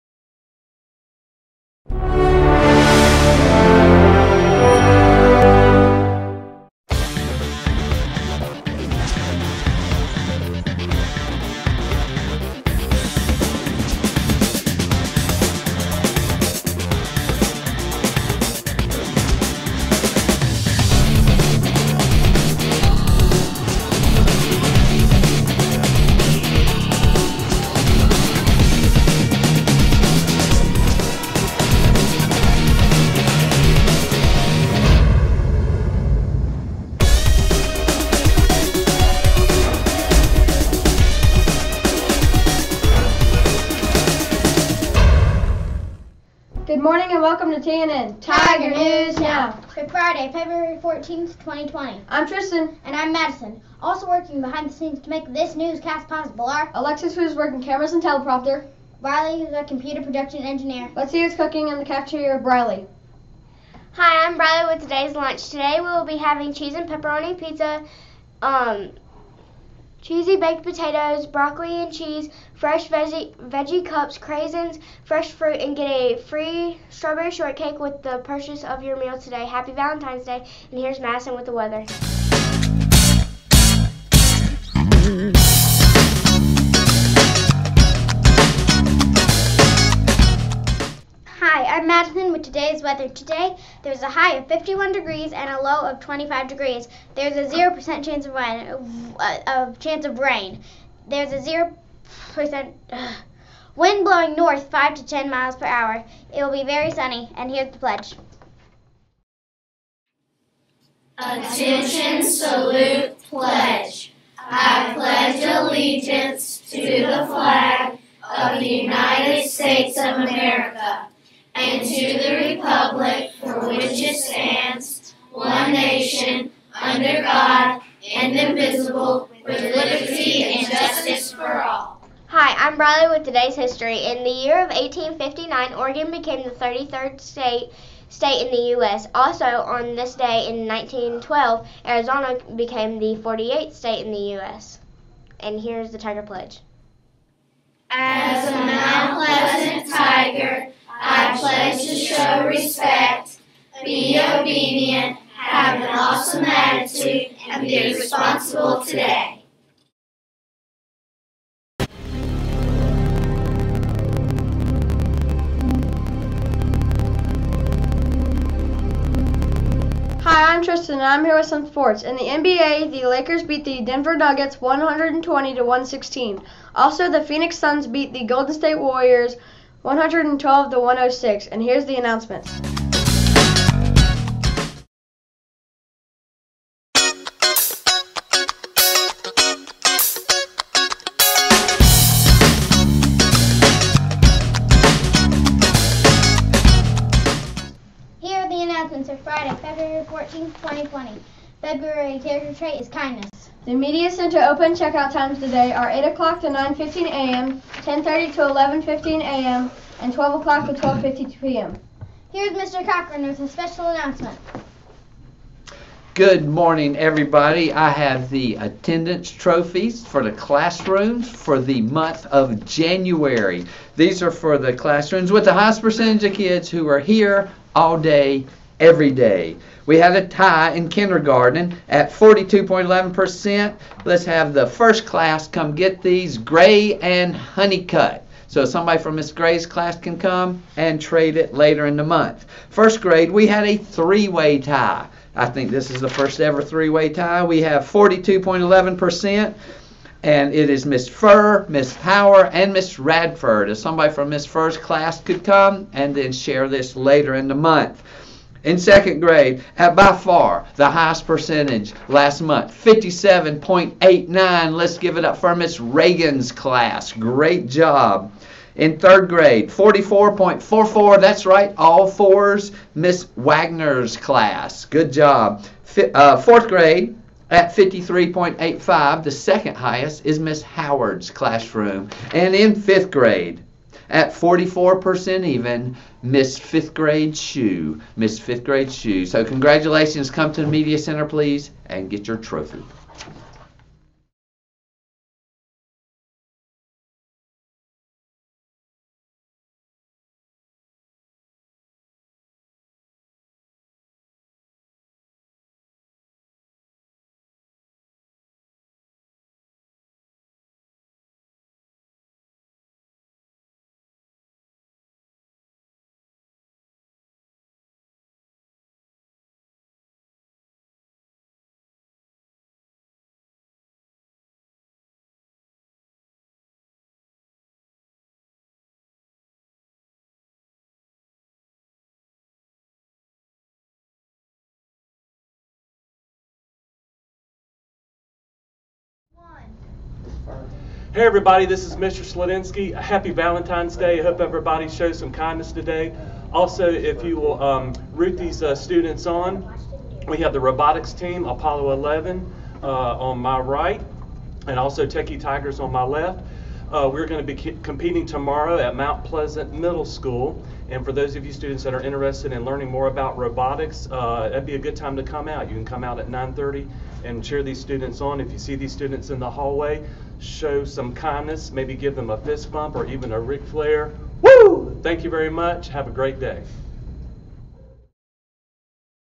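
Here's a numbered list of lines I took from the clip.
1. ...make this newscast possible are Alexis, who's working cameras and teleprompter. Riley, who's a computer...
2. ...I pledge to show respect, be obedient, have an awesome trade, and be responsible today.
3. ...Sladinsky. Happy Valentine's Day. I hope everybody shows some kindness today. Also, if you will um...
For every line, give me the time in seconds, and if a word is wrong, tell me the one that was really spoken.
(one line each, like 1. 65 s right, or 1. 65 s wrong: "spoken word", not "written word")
1. 55 s right
2. 151 s wrong: "attitude", not "trade"
3. 342 s right.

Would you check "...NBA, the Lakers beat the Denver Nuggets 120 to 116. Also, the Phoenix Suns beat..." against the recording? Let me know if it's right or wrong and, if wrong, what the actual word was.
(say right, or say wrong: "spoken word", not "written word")
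right.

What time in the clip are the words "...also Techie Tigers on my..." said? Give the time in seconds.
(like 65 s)
354 s.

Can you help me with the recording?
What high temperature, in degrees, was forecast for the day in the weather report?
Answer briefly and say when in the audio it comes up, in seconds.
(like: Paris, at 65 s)
51, at 94 s.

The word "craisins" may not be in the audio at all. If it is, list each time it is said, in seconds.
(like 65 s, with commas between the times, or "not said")
74 s.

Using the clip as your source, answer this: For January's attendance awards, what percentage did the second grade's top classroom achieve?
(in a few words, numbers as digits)
57.89%.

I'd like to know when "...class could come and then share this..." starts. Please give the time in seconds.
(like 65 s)
254 s.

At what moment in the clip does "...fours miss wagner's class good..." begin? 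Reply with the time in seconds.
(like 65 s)
272 s.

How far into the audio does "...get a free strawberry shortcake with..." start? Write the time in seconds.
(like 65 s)
75 s.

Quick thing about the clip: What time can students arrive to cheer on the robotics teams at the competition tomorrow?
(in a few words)
9:30.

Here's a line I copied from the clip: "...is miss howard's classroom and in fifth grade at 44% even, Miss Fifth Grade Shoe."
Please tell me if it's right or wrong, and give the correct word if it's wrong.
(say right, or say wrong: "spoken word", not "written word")
right.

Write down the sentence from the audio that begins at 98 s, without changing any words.
Of, uh, of chance of rain.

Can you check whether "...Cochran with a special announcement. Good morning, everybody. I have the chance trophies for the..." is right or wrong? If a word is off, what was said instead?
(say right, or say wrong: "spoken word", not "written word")
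wrong: "attendance", not "chance".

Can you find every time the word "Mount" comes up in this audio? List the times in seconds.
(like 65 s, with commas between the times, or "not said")
148 s, 358 s.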